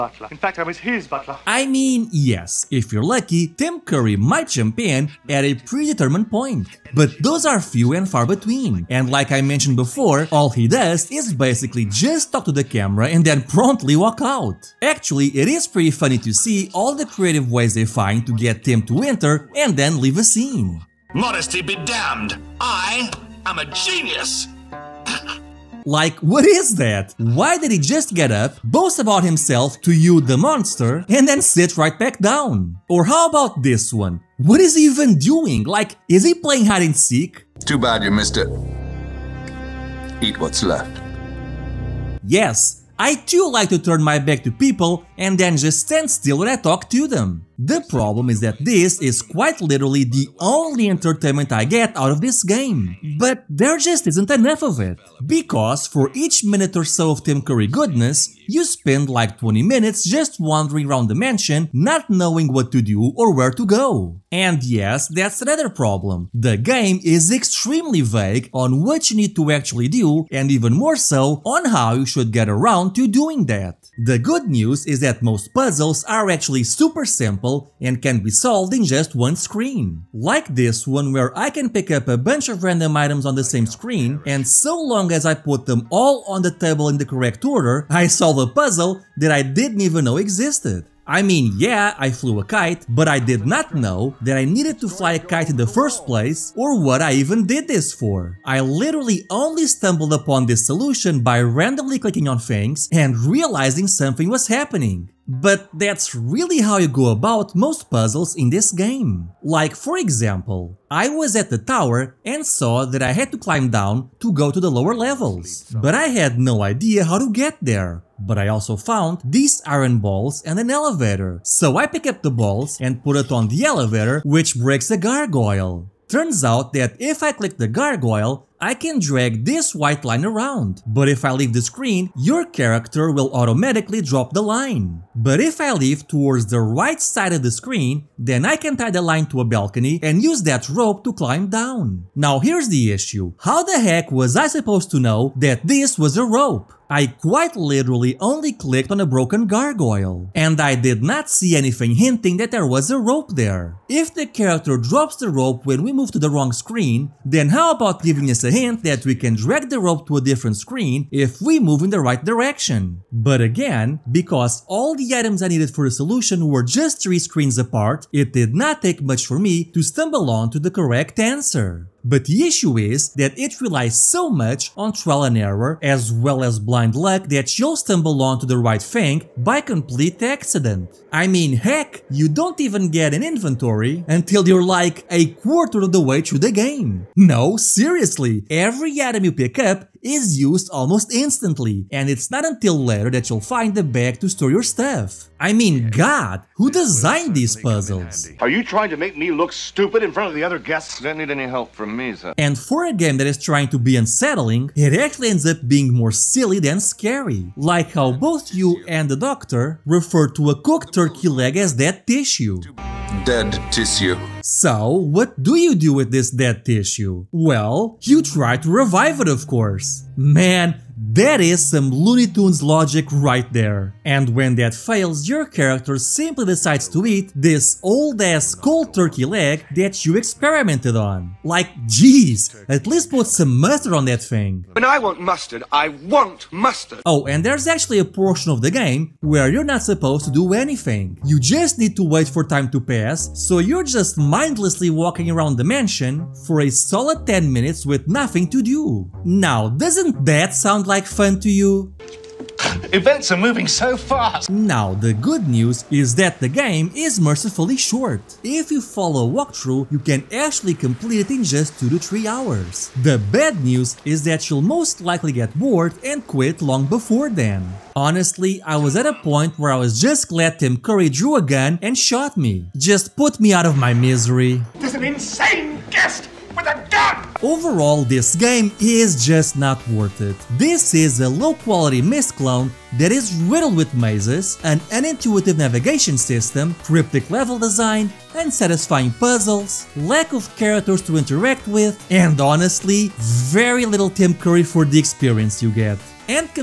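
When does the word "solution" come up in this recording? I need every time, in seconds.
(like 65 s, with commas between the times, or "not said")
100 s, 165 s.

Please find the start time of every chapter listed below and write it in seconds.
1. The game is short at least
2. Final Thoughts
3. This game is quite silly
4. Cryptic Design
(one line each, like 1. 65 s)
1. 253 s
2. 276 s
3. 202 s
4. 64 s.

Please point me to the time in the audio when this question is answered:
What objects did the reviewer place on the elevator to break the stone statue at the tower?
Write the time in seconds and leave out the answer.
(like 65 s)
119 s.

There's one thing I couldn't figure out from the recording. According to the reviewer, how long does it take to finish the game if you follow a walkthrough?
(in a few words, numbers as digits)
2 to 3 hours.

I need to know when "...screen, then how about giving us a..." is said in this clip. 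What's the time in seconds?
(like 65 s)
156 s.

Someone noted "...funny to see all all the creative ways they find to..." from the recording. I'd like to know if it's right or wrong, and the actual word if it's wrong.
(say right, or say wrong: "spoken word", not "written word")
right.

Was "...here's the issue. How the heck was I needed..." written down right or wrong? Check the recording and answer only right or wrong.
wrong.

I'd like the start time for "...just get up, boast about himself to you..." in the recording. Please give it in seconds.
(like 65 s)
27 s.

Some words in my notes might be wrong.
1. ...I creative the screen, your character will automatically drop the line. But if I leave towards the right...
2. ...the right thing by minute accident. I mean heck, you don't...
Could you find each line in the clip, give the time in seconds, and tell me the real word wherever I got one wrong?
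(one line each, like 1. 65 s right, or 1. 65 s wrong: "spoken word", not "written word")
1. 131 s wrong: "leave", not "creative"
2. 178 s wrong: "complete", not "minute".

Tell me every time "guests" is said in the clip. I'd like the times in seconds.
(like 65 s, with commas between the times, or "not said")
200 s, 275 s.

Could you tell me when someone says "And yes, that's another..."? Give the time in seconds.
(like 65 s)
64 s.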